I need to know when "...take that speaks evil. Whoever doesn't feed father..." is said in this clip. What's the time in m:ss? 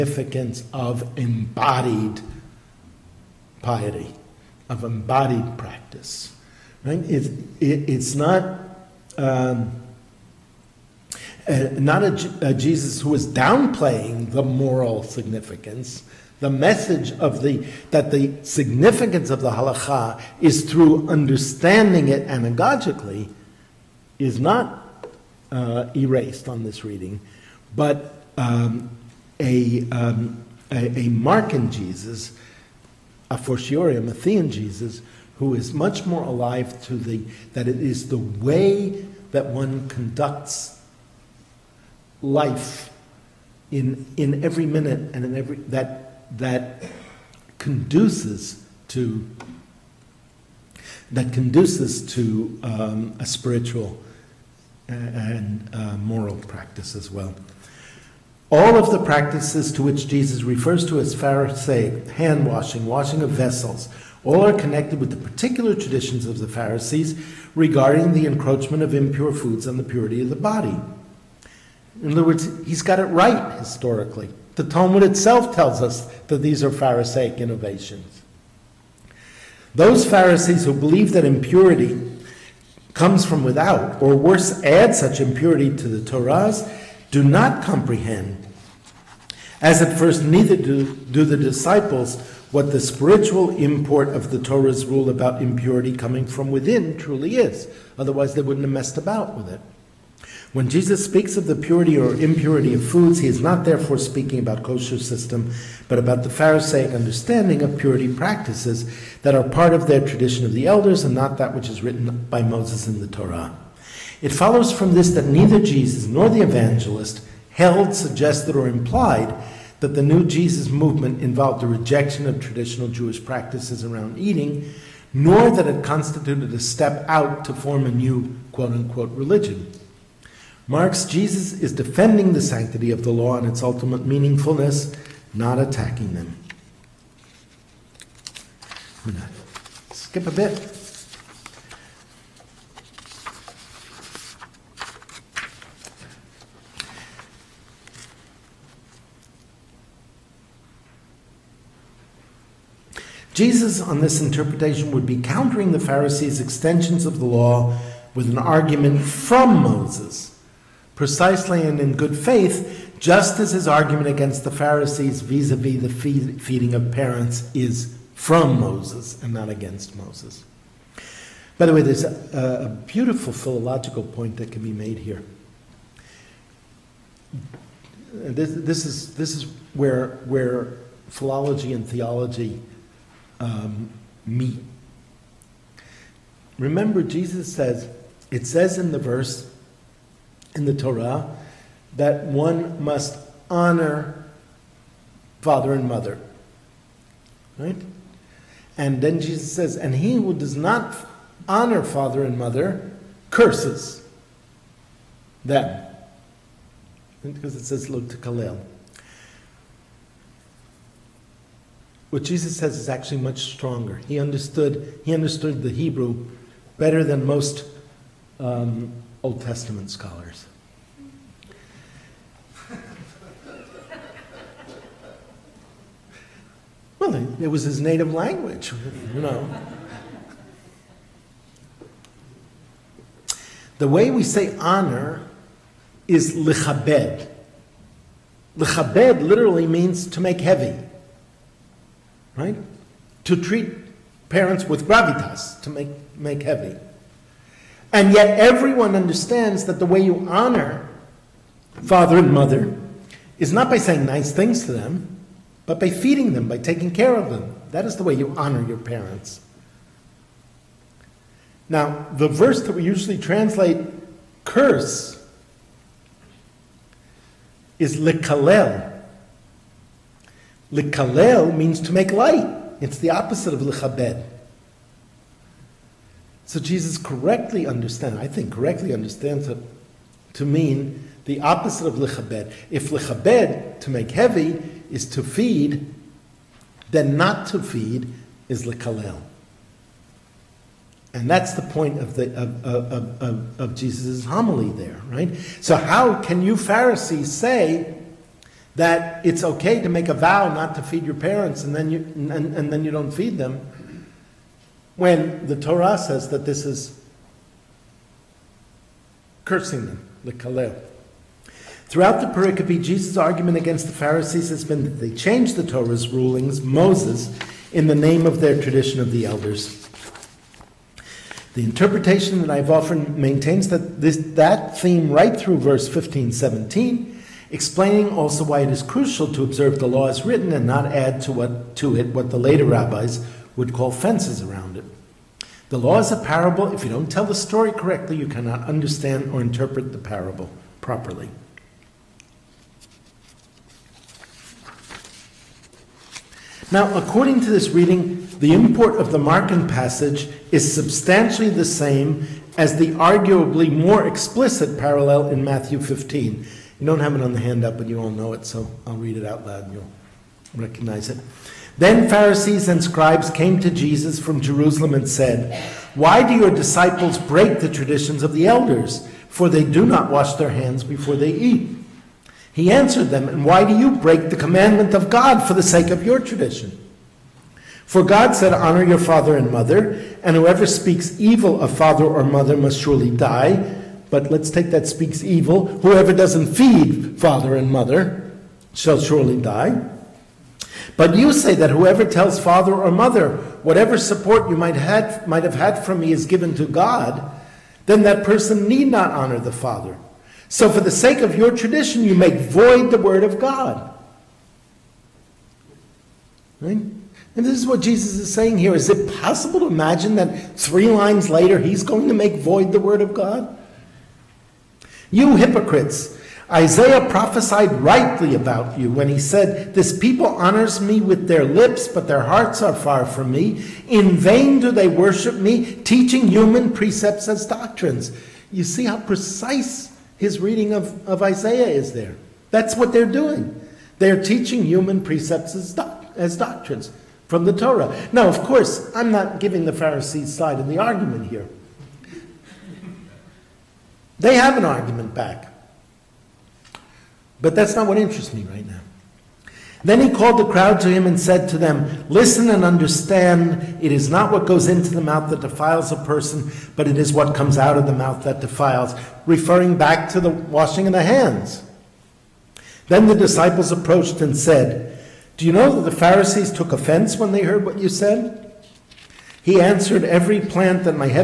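6:24.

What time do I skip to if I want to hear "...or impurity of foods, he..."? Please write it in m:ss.
1:41.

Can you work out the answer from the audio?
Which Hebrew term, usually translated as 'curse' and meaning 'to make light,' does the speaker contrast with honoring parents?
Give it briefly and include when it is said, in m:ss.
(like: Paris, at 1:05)
lekalel, at 4:27.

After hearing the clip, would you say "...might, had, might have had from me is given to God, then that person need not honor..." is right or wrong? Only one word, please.
right.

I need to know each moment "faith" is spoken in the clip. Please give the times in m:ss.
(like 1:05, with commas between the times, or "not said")
2:42.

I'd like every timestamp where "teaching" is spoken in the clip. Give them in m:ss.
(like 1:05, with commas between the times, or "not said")
7:05, 7:14.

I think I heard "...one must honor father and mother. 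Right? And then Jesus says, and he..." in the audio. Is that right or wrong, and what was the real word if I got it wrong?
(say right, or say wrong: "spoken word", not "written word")
right.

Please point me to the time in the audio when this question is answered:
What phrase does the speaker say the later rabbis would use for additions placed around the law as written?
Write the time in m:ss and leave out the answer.
5:33.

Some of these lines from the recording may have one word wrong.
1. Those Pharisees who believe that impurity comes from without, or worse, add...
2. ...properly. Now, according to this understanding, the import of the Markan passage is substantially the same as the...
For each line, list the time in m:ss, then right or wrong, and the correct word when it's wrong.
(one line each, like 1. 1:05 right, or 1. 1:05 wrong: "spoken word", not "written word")
1. 1:19 right
2. 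5:40 wrong: "reading", not "understanding".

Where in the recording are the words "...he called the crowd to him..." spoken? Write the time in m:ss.
7:30.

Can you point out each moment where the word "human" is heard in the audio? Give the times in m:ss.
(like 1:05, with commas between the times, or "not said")
7:06, 7:14.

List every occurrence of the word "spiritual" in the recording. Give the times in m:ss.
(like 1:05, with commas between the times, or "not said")
0:53, 1:32.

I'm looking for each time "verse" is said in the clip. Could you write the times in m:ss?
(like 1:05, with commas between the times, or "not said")
3:08, 4:22, 5:25.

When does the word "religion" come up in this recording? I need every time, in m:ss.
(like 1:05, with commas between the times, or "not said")
2:09.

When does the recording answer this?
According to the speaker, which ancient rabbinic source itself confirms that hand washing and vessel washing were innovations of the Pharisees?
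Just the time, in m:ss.
1:14.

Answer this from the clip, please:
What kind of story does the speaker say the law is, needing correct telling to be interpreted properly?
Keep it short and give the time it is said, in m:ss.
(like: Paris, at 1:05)
A parable, at 5:35.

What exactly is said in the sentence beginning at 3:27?
Because it says, look to Kalel.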